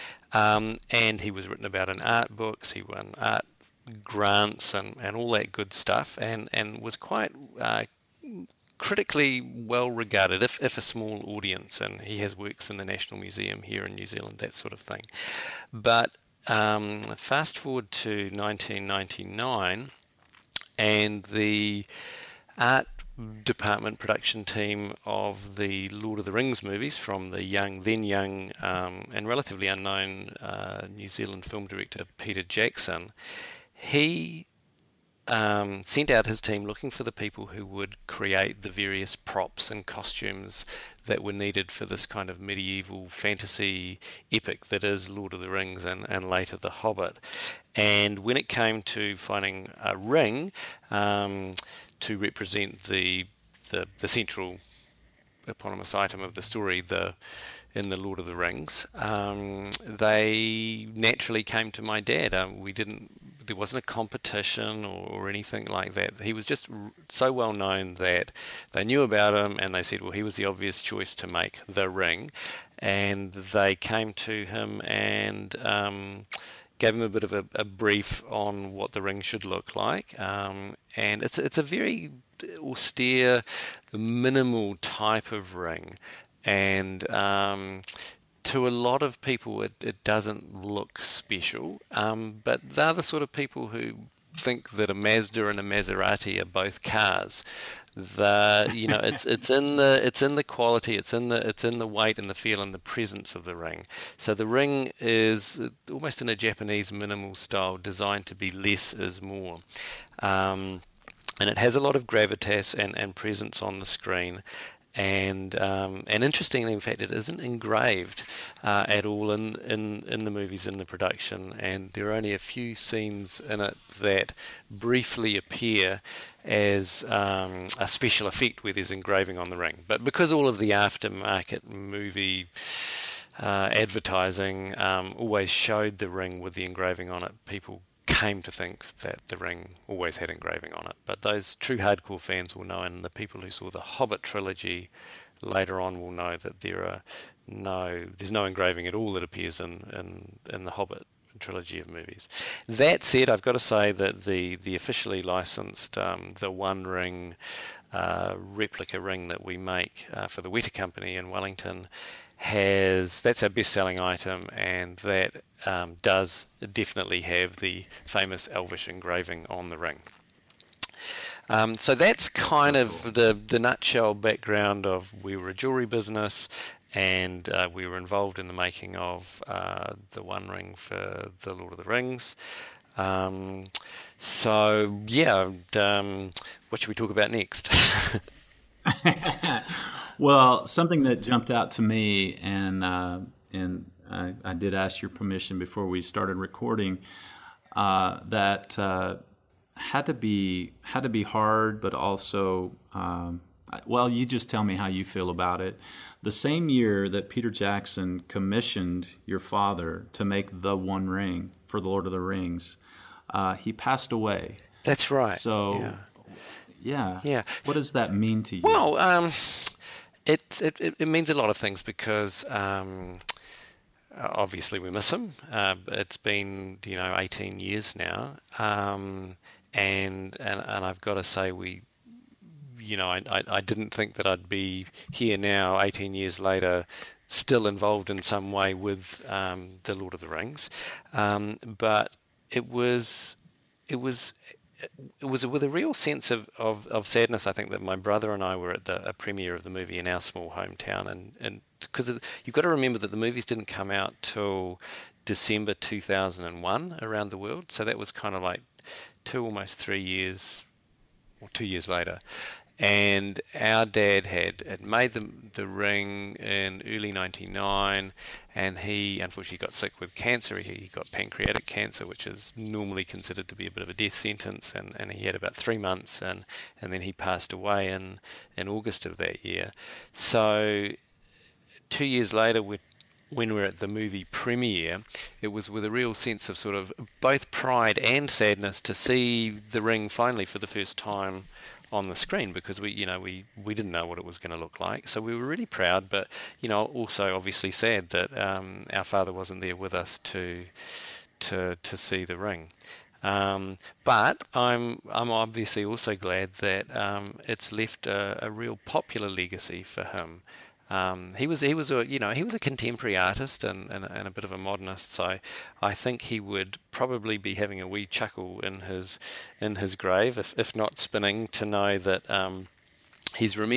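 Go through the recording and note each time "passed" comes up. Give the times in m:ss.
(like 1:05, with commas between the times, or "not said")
3:33, 4:37.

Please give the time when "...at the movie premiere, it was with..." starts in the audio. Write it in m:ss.
4:43.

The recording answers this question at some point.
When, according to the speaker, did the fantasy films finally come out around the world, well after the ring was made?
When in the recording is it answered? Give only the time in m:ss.
4:15.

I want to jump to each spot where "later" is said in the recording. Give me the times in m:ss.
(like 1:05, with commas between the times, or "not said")
0:46, 2:25, 3:56, 4:21, 4:42.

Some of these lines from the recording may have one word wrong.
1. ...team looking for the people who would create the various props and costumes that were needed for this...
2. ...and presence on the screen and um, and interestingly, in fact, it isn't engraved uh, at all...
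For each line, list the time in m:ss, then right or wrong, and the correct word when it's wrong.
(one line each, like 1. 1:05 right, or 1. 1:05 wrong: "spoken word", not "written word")
1. 0:36 right
2. 1:52 right.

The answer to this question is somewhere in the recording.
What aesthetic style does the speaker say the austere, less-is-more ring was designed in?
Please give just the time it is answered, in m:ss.
1:46.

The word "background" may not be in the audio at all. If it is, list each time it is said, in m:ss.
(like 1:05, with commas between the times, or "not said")
2:54.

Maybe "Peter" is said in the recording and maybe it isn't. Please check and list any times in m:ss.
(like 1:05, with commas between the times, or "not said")
0:32, 3:27.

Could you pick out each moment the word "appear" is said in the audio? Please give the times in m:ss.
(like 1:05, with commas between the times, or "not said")
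2:05, 2:29.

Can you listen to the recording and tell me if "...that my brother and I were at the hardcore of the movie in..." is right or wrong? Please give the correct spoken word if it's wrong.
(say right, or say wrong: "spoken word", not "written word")
wrong: "premiere", not "hardcore".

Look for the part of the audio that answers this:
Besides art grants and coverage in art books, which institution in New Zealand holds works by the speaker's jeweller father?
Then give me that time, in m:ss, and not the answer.
0:12.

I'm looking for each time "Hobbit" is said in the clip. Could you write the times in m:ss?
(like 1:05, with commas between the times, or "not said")
0:46, 2:23, 2:30.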